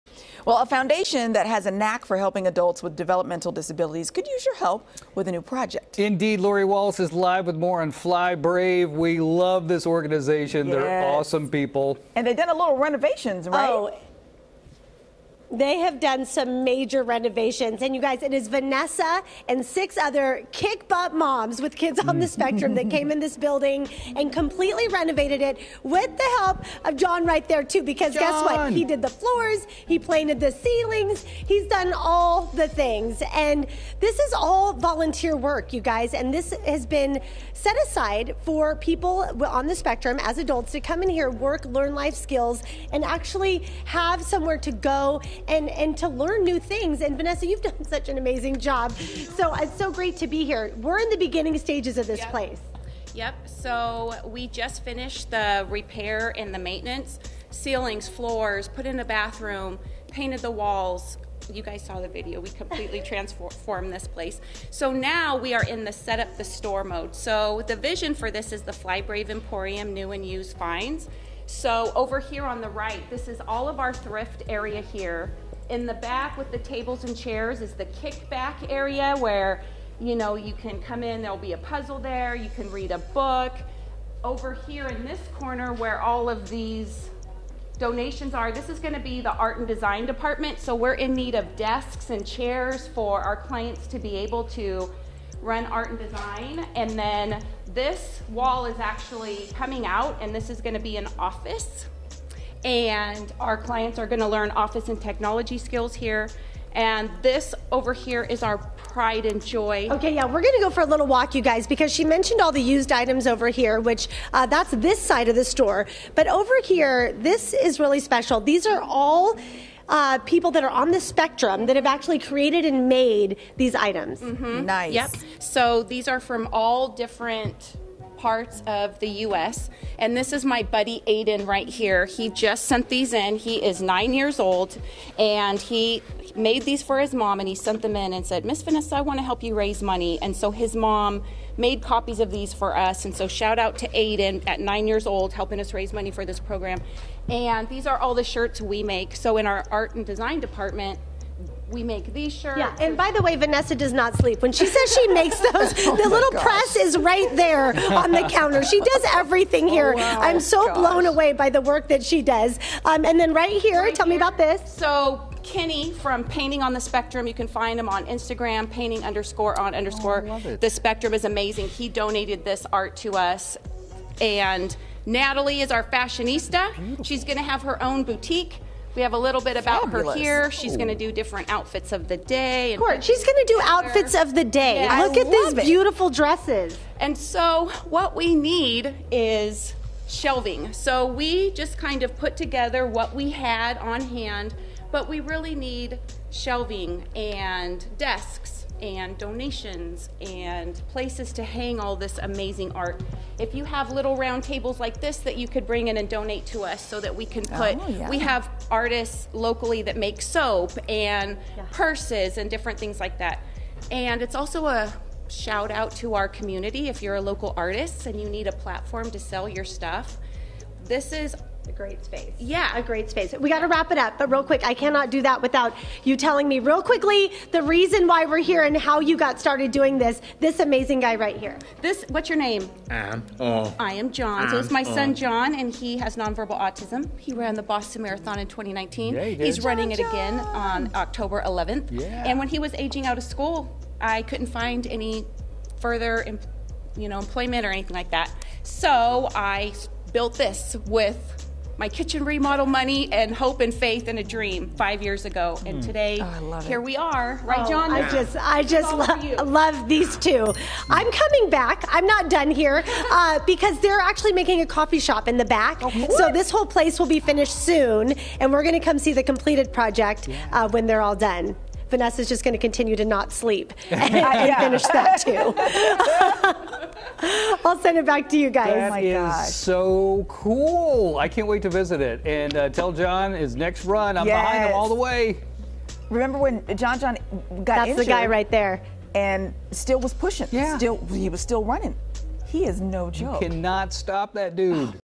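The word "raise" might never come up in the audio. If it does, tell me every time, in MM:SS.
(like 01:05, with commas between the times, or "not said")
02:19, 02:25.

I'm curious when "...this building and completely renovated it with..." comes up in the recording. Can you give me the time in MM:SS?
00:23.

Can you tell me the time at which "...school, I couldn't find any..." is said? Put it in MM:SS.
04:03.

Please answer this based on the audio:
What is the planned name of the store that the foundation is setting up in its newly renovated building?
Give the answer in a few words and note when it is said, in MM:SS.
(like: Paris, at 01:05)
Fly Brave Emporium, at 01:08.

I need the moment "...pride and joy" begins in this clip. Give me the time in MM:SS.
01:48.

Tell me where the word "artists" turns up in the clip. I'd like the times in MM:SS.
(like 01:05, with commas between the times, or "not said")
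03:28, 03:37.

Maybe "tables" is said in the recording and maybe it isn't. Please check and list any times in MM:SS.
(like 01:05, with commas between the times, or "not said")
01:16, 03:24.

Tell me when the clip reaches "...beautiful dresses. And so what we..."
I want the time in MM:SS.
03:05.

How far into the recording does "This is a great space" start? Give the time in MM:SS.
03:40.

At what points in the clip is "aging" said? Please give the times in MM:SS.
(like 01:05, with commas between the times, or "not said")
04:02.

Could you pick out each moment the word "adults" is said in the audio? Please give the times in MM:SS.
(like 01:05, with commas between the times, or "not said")
00:02, 00:40.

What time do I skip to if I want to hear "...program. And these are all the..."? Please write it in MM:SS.
02:26.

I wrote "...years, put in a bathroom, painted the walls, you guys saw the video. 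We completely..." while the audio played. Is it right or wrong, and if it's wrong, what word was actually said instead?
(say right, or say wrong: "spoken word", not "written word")
wrong: "floors", not "years".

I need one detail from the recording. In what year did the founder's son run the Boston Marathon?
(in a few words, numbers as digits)
2019.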